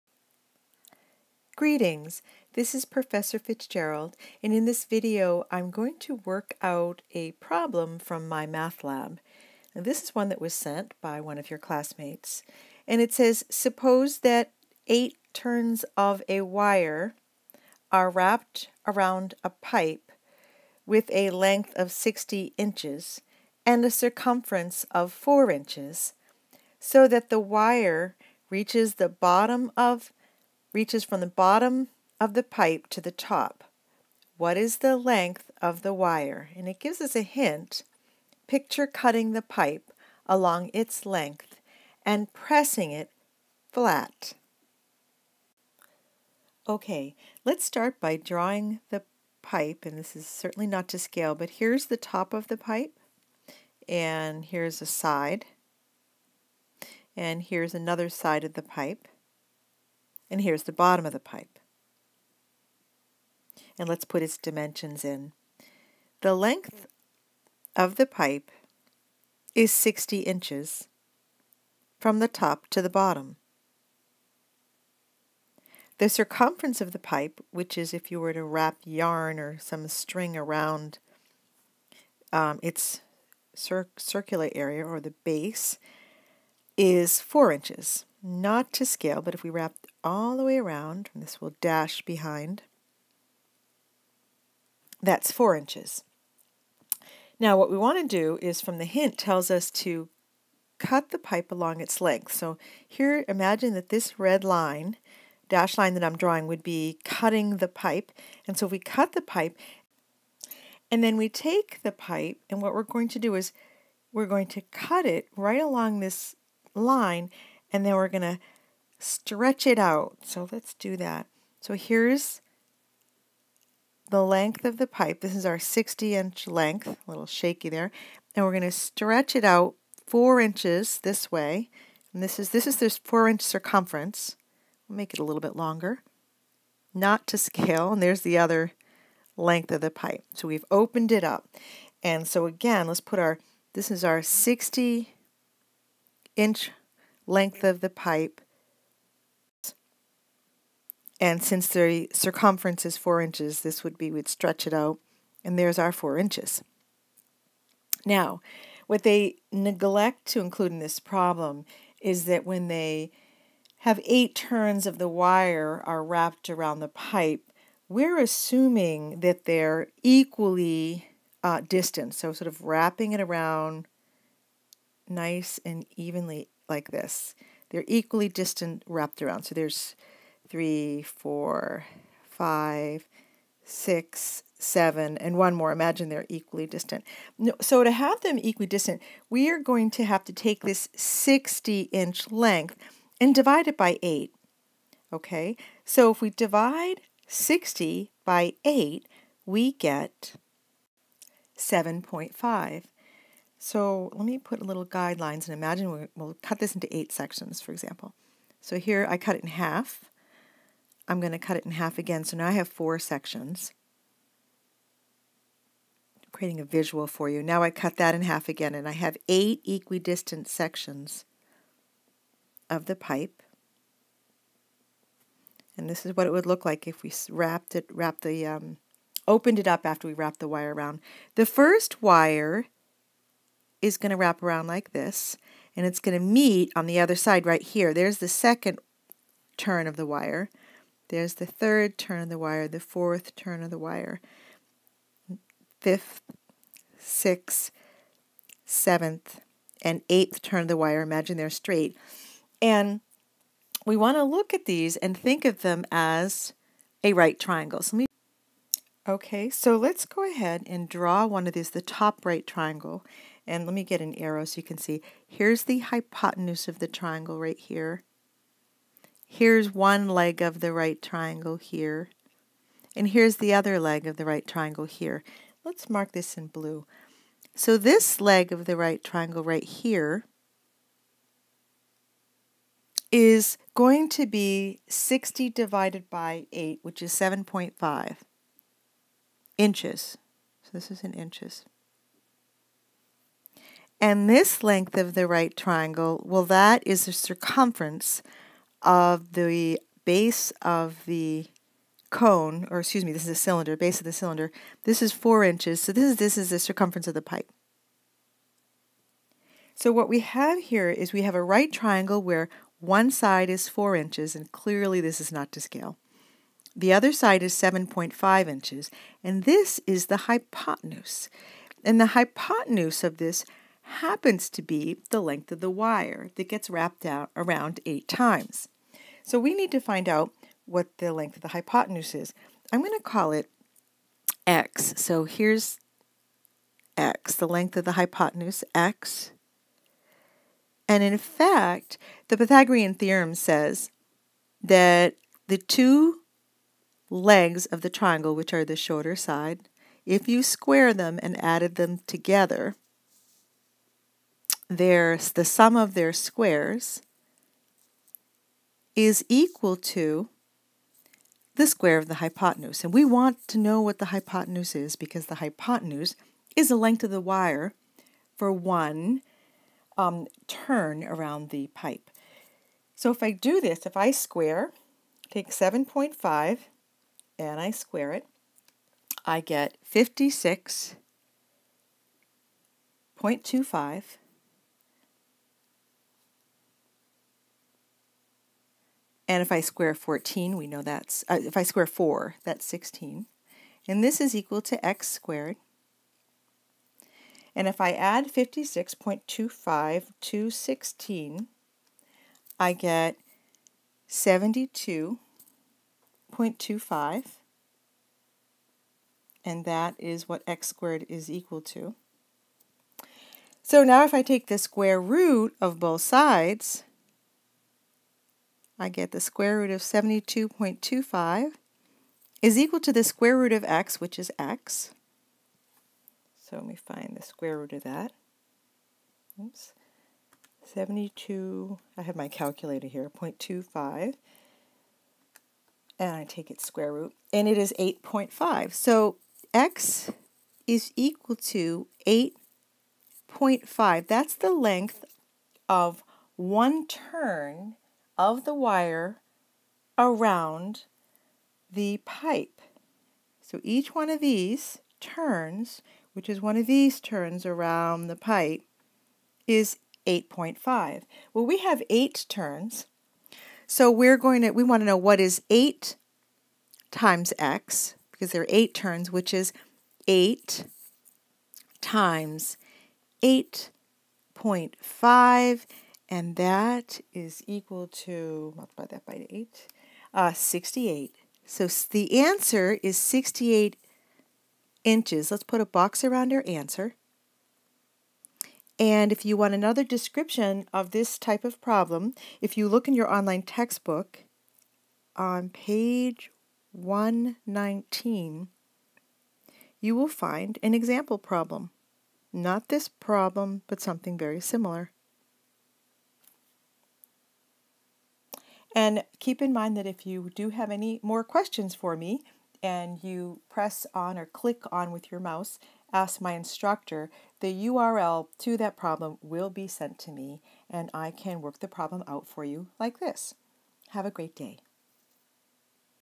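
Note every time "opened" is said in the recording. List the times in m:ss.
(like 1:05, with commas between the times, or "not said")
2:20, 3:49.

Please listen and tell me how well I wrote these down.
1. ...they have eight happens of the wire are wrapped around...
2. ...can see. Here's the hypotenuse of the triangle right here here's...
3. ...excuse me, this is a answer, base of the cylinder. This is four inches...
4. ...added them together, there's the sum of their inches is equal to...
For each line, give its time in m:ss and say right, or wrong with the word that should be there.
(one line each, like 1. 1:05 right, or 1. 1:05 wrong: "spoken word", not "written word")
1. 2:42 wrong: "turns", not "happens"
2. 4:24 right
3. 5:02 wrong: "cylinder", not "answer"
4. 5:51 wrong: "squares", not "inches".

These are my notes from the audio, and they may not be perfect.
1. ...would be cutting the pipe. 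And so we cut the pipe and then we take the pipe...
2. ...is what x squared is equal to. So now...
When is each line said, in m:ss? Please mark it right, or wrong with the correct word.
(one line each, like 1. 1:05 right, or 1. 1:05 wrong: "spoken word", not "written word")
1. 1:46 right
2. 6:49 right.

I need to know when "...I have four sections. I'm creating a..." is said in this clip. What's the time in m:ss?
3:32.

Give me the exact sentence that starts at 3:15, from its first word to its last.
Okay, so if we divide 60 by 8, we get 7.5.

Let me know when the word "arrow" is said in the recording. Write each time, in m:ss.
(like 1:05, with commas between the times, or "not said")
4:24.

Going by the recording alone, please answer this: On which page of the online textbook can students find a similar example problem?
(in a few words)
119.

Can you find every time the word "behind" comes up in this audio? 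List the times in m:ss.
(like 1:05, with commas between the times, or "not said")
1:32.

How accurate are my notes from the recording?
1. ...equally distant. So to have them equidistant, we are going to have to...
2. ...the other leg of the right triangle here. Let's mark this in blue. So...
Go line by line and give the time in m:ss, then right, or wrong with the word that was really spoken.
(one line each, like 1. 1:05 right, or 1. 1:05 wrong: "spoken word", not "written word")
1. 3:06 right
2. 4:33 right.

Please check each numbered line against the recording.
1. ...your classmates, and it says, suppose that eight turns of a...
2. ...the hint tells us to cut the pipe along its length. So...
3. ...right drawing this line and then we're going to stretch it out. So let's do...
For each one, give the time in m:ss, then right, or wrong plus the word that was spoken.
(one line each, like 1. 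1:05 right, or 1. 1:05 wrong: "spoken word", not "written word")
1. 0:11 right
2. 1:38 right
3. 1:55 wrong: "along", not "drawing".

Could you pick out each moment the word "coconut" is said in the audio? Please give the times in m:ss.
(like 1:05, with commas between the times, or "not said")
not said.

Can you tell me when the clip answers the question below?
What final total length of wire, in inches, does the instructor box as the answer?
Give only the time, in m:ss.
8:02.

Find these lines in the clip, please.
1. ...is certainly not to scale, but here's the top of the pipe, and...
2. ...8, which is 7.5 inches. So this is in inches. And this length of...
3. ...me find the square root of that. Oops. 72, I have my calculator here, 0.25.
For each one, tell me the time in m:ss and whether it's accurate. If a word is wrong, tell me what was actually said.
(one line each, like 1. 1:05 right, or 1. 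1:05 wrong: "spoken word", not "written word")
1. 0:50 right
2. 4:46 right
3. 7:06 right.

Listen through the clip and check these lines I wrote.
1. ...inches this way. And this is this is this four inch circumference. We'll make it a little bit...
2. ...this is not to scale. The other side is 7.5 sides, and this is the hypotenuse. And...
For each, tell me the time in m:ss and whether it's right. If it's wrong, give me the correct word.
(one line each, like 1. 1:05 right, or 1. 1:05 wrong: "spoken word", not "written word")
1. 2:10 right
2. 5:14 wrong: "inches", not "sides".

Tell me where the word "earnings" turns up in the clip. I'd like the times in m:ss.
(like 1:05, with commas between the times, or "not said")
not said.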